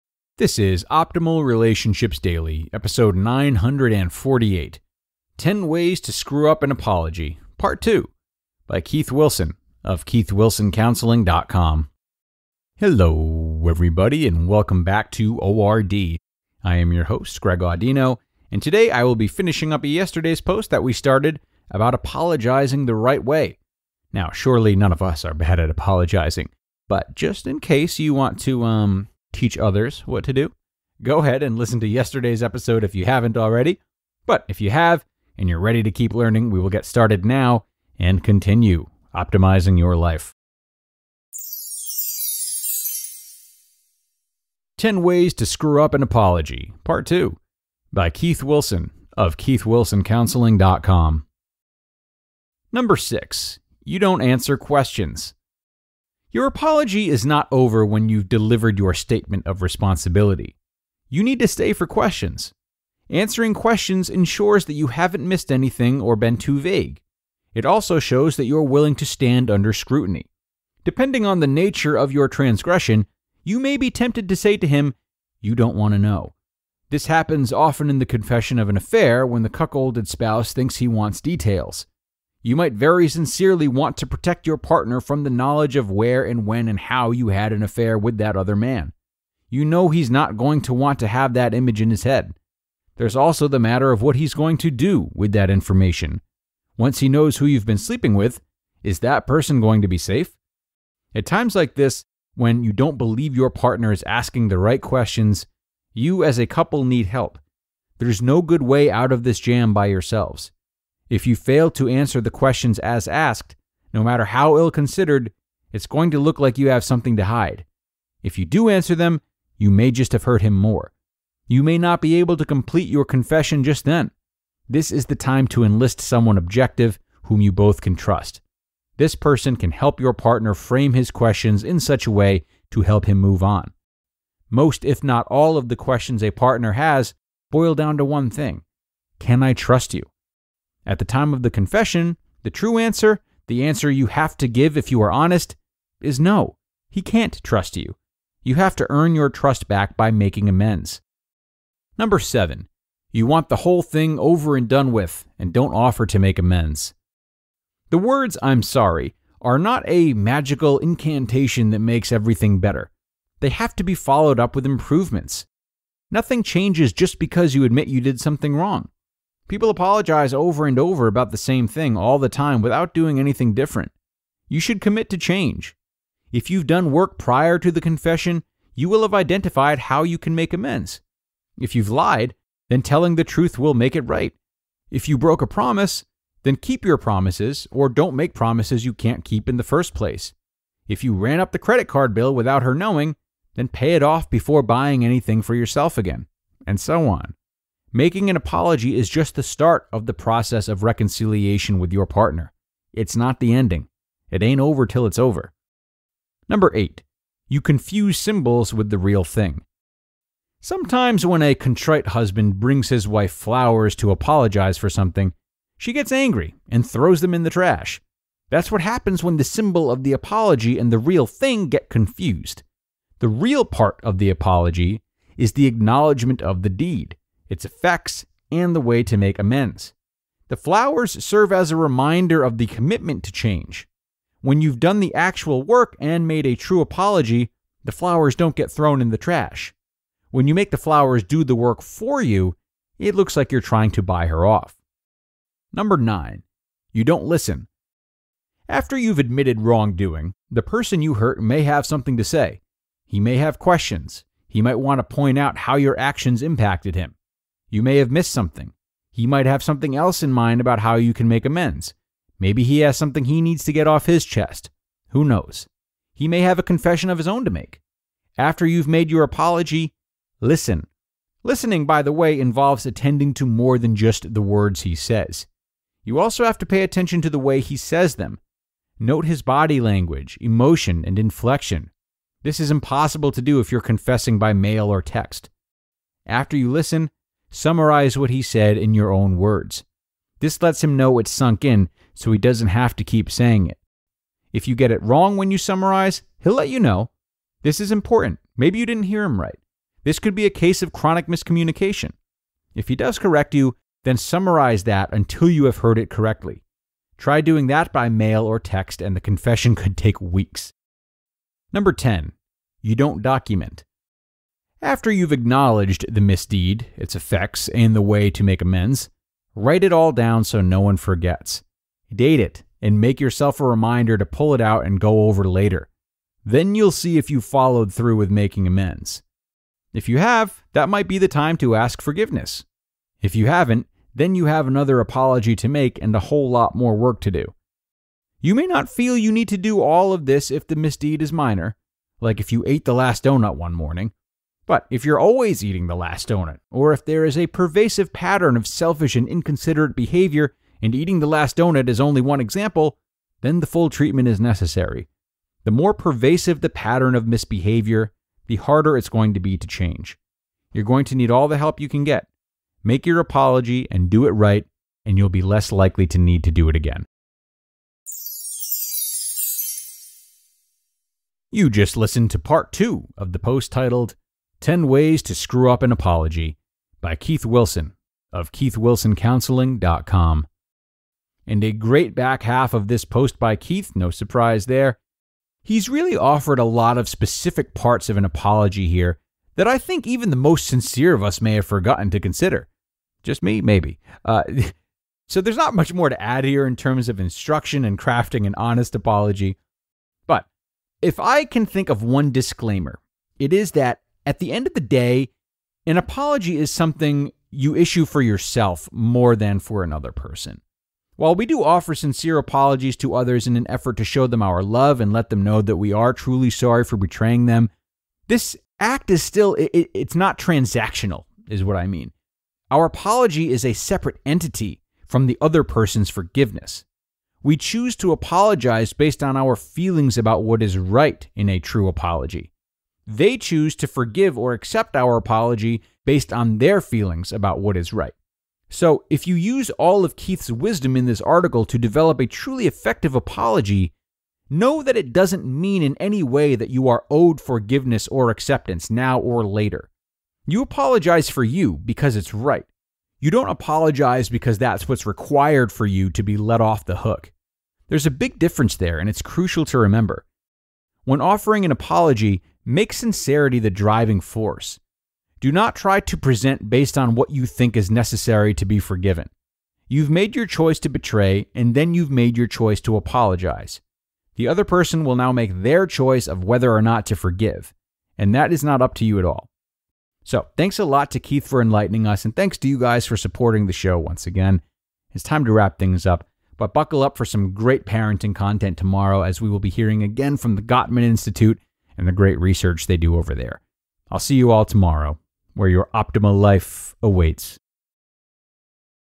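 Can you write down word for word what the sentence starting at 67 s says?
It also shows that you're willing to stand under scrutiny.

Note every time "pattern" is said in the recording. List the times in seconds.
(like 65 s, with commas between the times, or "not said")
348 s, 356 s.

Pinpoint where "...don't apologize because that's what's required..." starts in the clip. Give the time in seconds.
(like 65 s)
453 s.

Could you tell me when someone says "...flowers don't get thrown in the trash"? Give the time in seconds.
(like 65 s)
237 s.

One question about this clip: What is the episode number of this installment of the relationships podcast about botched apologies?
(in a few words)
948.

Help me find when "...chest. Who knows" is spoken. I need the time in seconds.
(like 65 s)
264 s.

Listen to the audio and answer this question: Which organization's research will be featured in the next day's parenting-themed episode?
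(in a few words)
Gottman Institute.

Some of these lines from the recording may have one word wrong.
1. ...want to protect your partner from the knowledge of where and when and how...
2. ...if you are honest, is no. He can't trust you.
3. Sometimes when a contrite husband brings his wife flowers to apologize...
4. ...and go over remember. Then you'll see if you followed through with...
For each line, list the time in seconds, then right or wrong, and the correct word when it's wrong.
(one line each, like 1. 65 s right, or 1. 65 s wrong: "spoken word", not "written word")
1. 83 s right
2. 144 s right
3. 210 s right
4. 324 s wrong: "later", not "remember".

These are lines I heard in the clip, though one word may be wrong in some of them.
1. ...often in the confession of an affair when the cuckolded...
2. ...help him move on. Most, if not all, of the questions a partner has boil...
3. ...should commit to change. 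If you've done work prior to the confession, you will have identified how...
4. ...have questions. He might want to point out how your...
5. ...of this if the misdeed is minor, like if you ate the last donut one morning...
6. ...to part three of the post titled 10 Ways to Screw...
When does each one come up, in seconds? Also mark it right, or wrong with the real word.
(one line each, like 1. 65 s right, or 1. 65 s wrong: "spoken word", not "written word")
1. 77 s right
2. 132 s right
3. 174 s right
4. 253 s right
5. 340 s right
6. 372 s wrong: "two", not "three".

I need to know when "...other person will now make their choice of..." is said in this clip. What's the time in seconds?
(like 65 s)
474 s.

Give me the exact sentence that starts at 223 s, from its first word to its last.
The real part of the apology is the acknowledgement of the deed its effects, and the way to make amends.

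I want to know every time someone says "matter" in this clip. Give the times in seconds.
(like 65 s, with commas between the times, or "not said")
93 s, 114 s.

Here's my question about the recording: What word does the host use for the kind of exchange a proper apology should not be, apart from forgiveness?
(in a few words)
Transactional.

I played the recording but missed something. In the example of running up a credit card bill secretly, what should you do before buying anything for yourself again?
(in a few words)
Pay it off.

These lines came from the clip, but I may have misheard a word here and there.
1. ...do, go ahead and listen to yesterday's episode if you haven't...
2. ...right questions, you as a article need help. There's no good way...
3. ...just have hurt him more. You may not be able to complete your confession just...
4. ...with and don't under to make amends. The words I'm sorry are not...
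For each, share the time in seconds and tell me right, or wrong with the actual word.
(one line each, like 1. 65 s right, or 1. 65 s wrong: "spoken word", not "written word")
1. 30 s right
2. 104 s wrong: "couple", not "article"
3. 119 s right
4. 154 s wrong: "offer", not "under".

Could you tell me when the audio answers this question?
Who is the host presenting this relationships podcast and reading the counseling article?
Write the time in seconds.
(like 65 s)
17 s.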